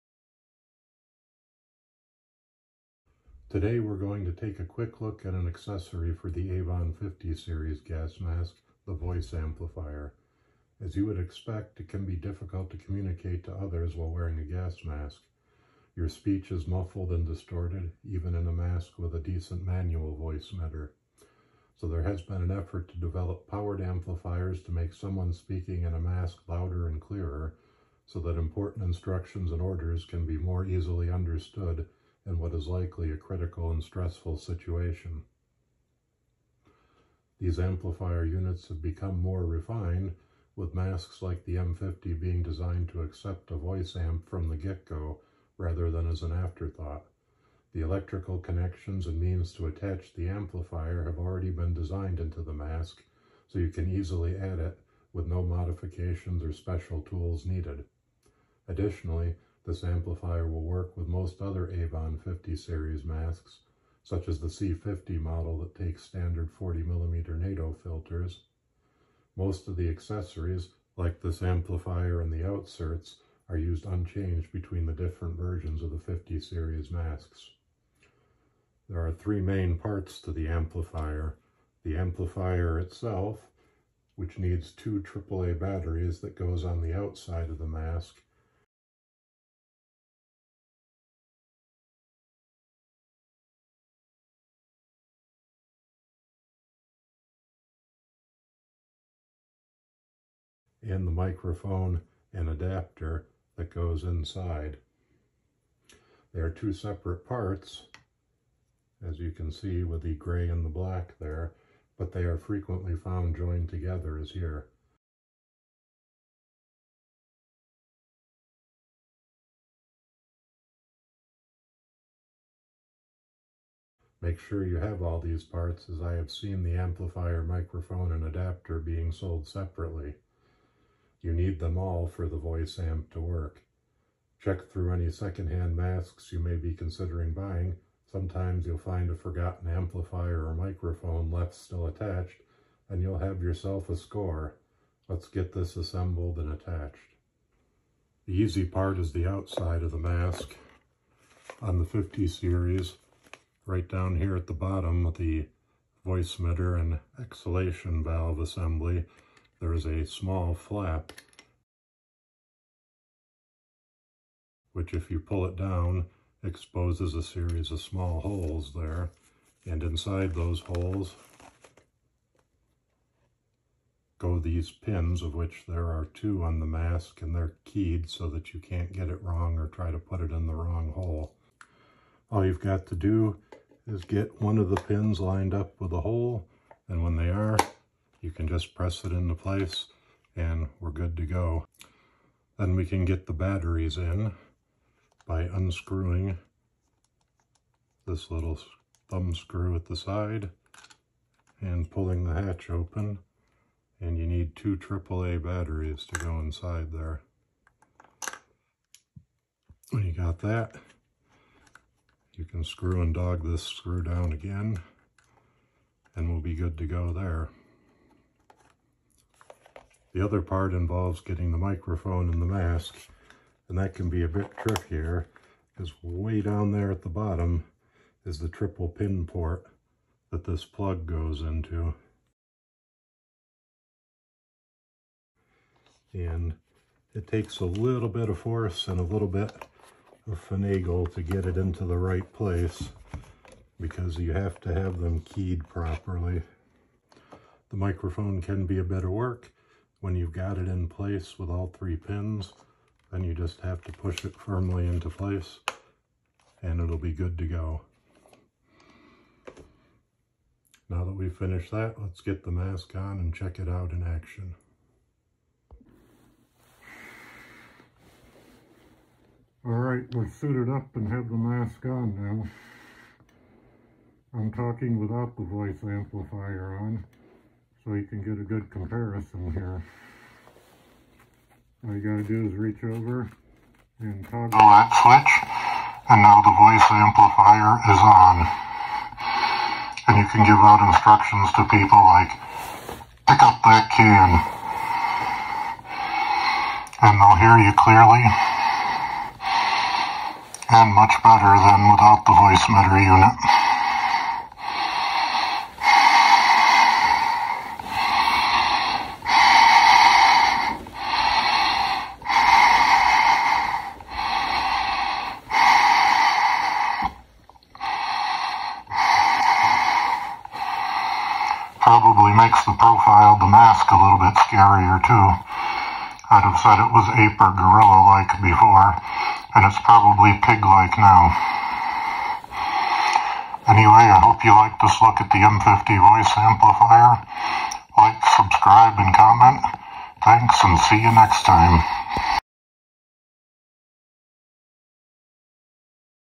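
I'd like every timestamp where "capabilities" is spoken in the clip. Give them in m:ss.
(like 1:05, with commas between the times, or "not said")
not said.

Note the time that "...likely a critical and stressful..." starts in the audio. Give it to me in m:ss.
0:32.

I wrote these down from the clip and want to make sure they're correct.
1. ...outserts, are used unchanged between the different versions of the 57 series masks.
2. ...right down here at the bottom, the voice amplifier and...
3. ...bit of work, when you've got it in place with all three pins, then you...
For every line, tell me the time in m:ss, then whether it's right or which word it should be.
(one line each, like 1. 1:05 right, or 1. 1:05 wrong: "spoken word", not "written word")
1. 1:12 wrong: "50", not "57"
2. 2:33 wrong: "emitter", not "amplifier"
3. 4:08 right.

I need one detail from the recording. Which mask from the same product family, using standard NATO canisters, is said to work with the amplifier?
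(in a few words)
C50.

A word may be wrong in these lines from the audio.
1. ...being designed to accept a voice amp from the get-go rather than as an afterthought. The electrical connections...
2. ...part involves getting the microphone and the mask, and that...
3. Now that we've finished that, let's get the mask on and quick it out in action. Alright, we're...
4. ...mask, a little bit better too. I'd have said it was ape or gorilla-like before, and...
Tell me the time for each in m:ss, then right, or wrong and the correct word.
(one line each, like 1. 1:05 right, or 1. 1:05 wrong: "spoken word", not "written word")
1. 0:42 right
2. 3:40 right
3. 4:20 wrong: "check", not "quick"
4. 5:23 wrong: "scarier", not "better".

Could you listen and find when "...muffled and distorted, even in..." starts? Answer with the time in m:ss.
0:16.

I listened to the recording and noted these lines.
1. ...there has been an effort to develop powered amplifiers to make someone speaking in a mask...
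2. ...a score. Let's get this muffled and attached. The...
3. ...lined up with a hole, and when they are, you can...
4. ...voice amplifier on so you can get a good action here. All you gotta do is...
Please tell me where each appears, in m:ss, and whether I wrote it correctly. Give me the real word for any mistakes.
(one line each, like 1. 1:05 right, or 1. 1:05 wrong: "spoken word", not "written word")
1. 0:21 right
2. 2:23 wrong: "assembled", not "muffled"
3. 3:05 right
4. 4:35 wrong: "comparison", not "action".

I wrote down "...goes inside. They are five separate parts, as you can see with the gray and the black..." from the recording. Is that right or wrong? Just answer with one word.
wrong.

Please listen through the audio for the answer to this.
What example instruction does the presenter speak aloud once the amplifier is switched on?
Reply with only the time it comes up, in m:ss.
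4:53.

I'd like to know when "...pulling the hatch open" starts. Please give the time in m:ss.
3:21.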